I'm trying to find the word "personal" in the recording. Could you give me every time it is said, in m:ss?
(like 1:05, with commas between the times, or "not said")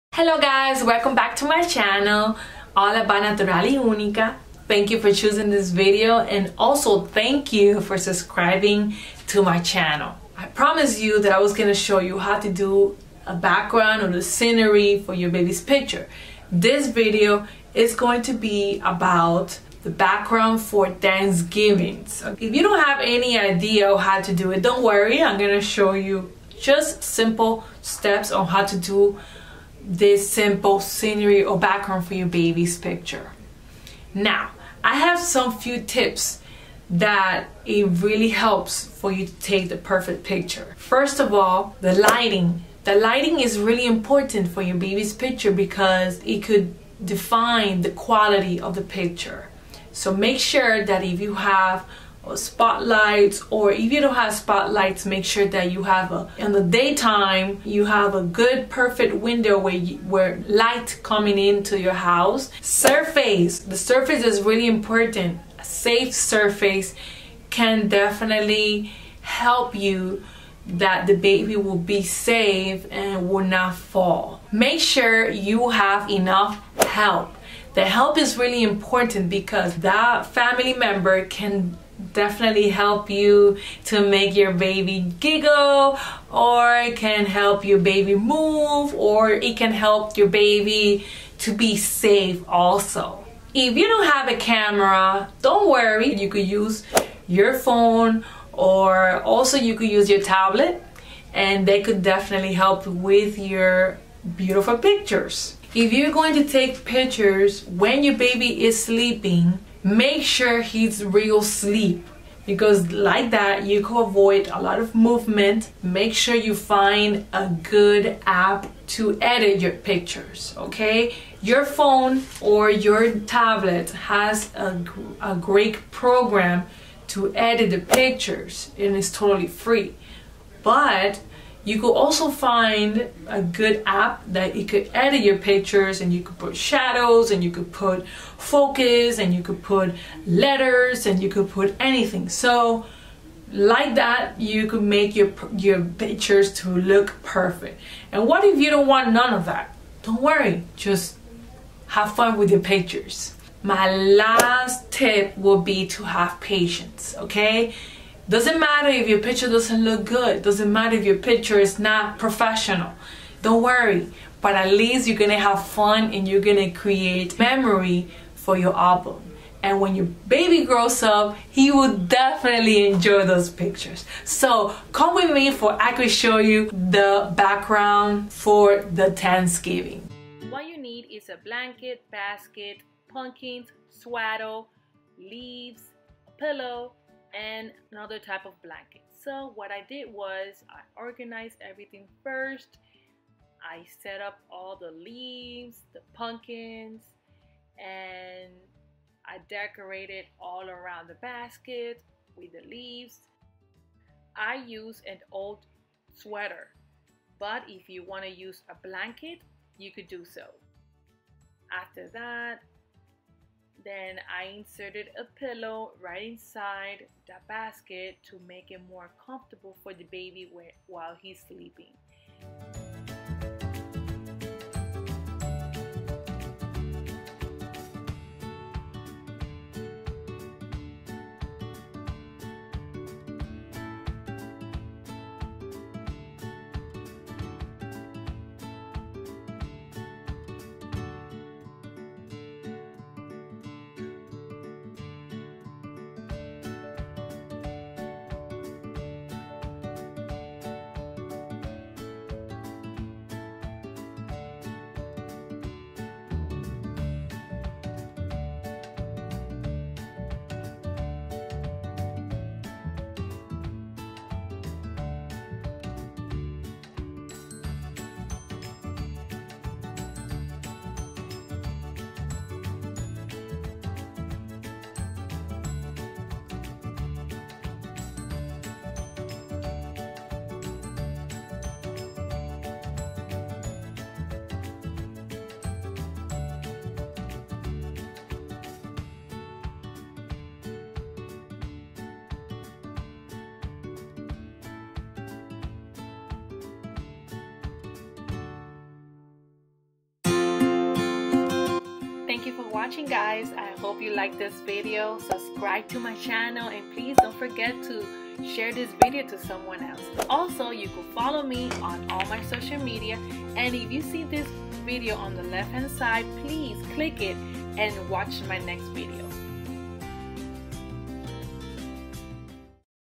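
not said.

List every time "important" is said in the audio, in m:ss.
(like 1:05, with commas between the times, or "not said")
0:43, 1:04, 1:18.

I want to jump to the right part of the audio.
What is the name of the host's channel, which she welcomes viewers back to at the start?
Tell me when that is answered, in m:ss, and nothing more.
0:02.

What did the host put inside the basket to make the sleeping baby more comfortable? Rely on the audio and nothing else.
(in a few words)
A pillow.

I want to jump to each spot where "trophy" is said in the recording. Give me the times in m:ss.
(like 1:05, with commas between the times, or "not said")
not said.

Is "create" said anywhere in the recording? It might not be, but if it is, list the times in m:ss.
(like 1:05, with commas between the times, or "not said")
2:46.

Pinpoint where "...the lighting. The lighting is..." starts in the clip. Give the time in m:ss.
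0:41.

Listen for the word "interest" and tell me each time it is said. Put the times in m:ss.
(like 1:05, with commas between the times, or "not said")
not said.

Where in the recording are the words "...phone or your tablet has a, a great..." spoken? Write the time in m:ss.
2:01.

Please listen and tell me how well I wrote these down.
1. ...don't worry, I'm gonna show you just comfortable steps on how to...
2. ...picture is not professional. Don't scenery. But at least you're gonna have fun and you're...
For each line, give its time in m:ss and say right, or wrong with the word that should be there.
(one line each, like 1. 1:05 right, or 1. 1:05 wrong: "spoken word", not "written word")
1. 0:24 wrong: "simple", not "comfortable"
2. 2:41 wrong: "worry", not "scenery".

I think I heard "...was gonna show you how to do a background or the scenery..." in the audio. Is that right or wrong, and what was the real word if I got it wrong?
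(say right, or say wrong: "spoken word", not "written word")
right.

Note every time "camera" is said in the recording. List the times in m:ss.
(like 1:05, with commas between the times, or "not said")
1:34.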